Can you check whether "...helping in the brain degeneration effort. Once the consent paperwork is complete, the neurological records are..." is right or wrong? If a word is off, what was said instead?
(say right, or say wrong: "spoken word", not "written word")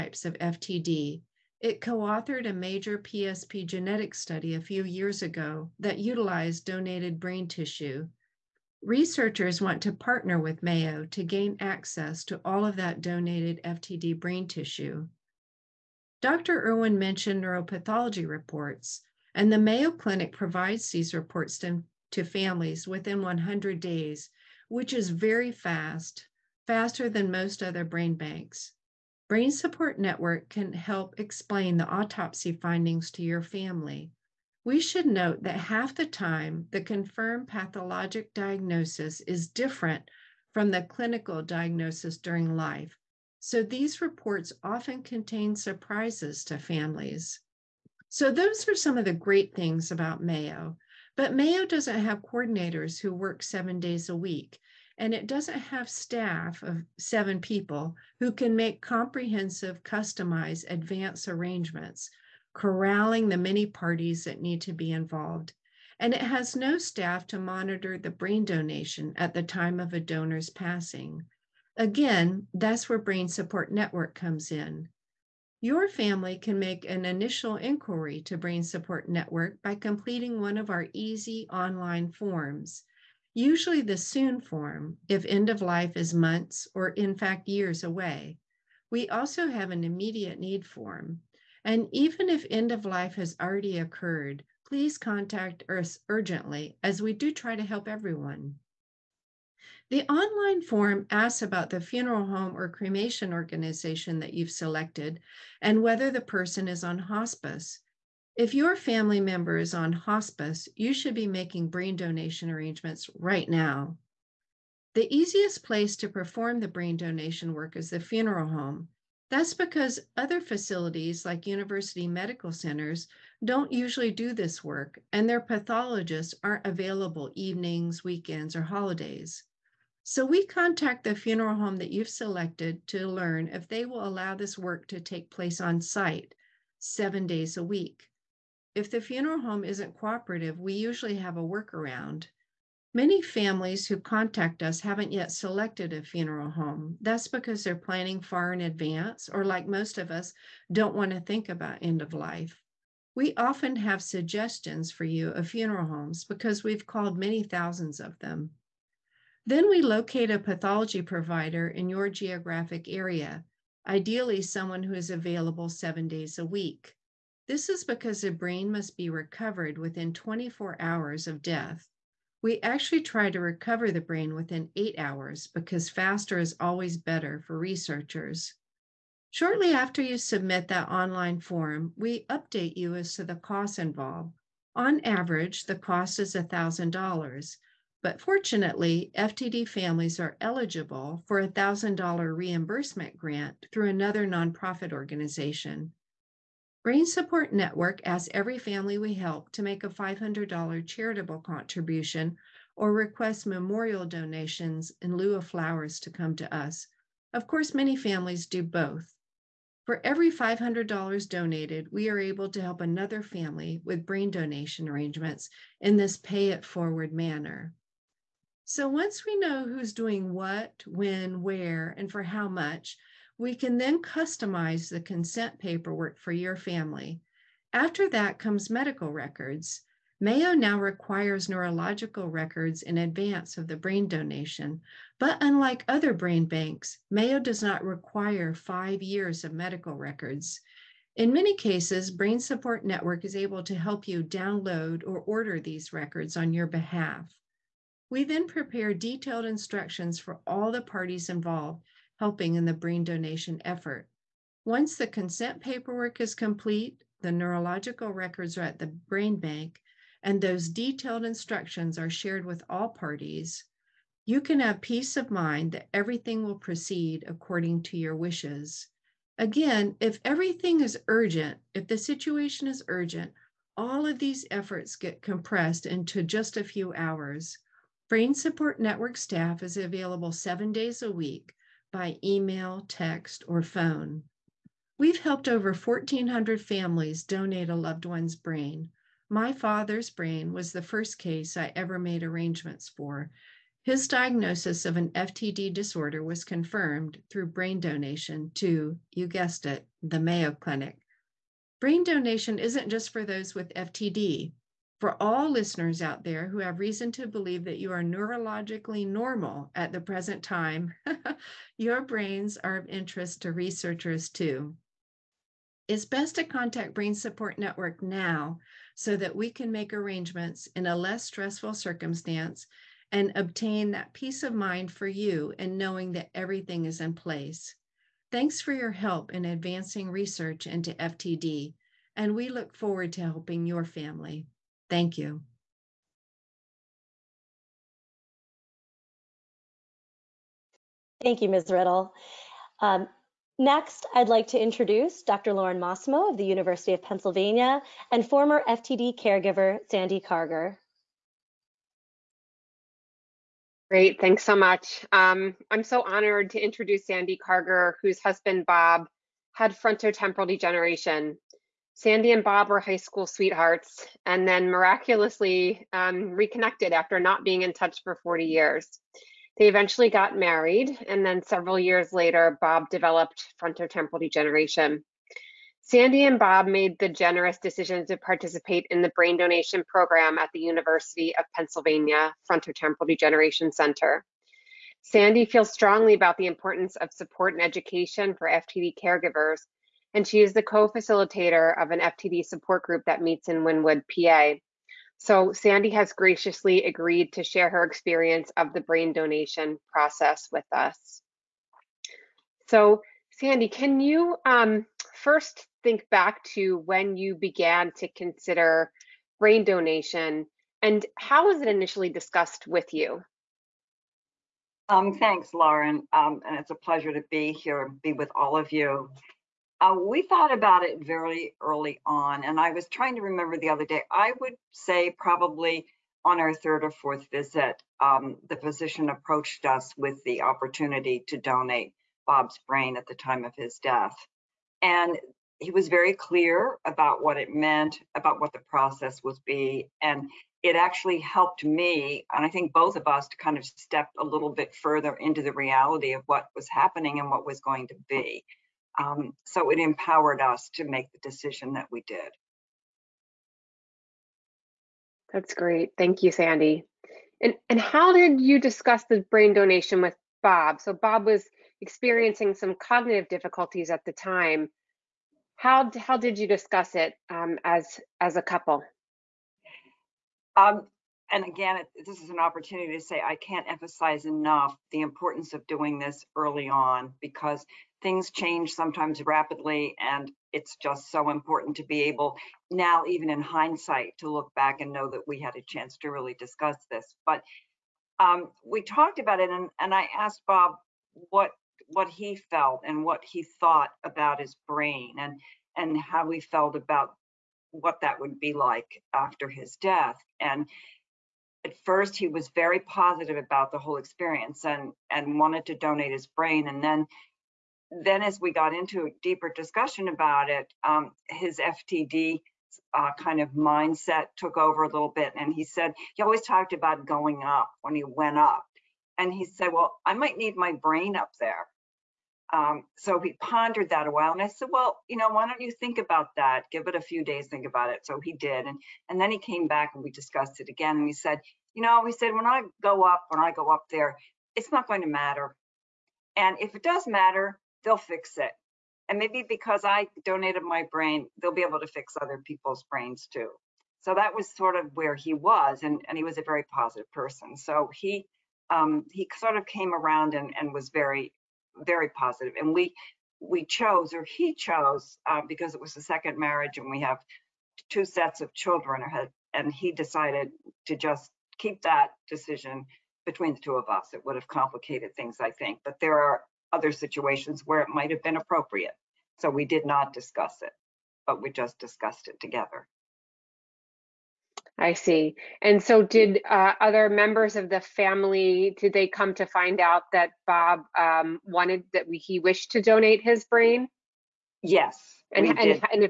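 wrong: "donation", not "degeneration".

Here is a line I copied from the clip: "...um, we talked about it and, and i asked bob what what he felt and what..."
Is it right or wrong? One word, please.
right.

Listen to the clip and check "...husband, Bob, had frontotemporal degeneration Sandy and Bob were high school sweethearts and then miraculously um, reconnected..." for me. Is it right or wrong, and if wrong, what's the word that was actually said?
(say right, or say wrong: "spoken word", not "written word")
right.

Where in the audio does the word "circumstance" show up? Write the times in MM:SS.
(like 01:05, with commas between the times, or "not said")
05:21.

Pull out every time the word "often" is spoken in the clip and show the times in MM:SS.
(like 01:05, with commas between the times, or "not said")
00:44, 02:33.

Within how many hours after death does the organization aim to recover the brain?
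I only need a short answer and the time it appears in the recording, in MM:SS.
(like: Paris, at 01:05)
8 hours, at 02:54.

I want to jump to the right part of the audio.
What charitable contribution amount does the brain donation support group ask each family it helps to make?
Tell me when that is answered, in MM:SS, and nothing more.
03:19.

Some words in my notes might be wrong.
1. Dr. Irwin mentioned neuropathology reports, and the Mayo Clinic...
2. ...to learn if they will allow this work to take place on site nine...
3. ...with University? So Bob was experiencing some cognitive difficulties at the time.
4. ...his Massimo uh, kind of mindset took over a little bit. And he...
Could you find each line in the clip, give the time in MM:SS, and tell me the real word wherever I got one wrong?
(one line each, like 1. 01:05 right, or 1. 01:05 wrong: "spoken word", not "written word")
1. 00:16 right
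2. 02:12 wrong: "seven", not "nine"
3. 07:40 wrong: "Bob", not "University"
4. 08:31 wrong: "FTD", not "Massimo".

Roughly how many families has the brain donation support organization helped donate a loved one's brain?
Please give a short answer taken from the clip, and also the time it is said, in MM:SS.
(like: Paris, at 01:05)
1,400, at 04:45.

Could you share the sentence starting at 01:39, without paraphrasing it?
The online form asks about the funeral home or cremation organization that you've selected and whether the person is on hospice.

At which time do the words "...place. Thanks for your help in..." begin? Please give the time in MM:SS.
05:27.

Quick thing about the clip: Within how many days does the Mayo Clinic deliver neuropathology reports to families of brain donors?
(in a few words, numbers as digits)
100 days.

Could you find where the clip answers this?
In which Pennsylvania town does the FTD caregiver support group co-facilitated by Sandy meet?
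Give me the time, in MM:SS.
06:33.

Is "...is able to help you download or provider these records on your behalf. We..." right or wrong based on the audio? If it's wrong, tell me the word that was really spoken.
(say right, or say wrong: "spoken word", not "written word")
wrong: "order", not "provider".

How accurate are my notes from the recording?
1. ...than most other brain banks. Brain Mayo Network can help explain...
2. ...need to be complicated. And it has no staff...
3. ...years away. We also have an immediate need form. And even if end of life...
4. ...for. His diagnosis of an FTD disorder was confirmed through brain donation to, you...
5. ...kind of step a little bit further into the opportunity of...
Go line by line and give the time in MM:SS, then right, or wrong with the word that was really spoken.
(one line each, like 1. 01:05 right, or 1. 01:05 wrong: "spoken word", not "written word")
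1. 00:27 wrong: "Support", not "Mayo"
2. 01:04 wrong: "involved", not "complicated"
3. 01:27 right
4. 04:52 right
5. 07:23 wrong: "reality", not "opportunity".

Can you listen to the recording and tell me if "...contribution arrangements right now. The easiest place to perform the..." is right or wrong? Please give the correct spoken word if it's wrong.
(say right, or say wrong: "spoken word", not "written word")
wrong: "donation", not "contribution".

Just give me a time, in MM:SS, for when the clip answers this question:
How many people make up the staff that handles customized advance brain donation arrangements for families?
00:56.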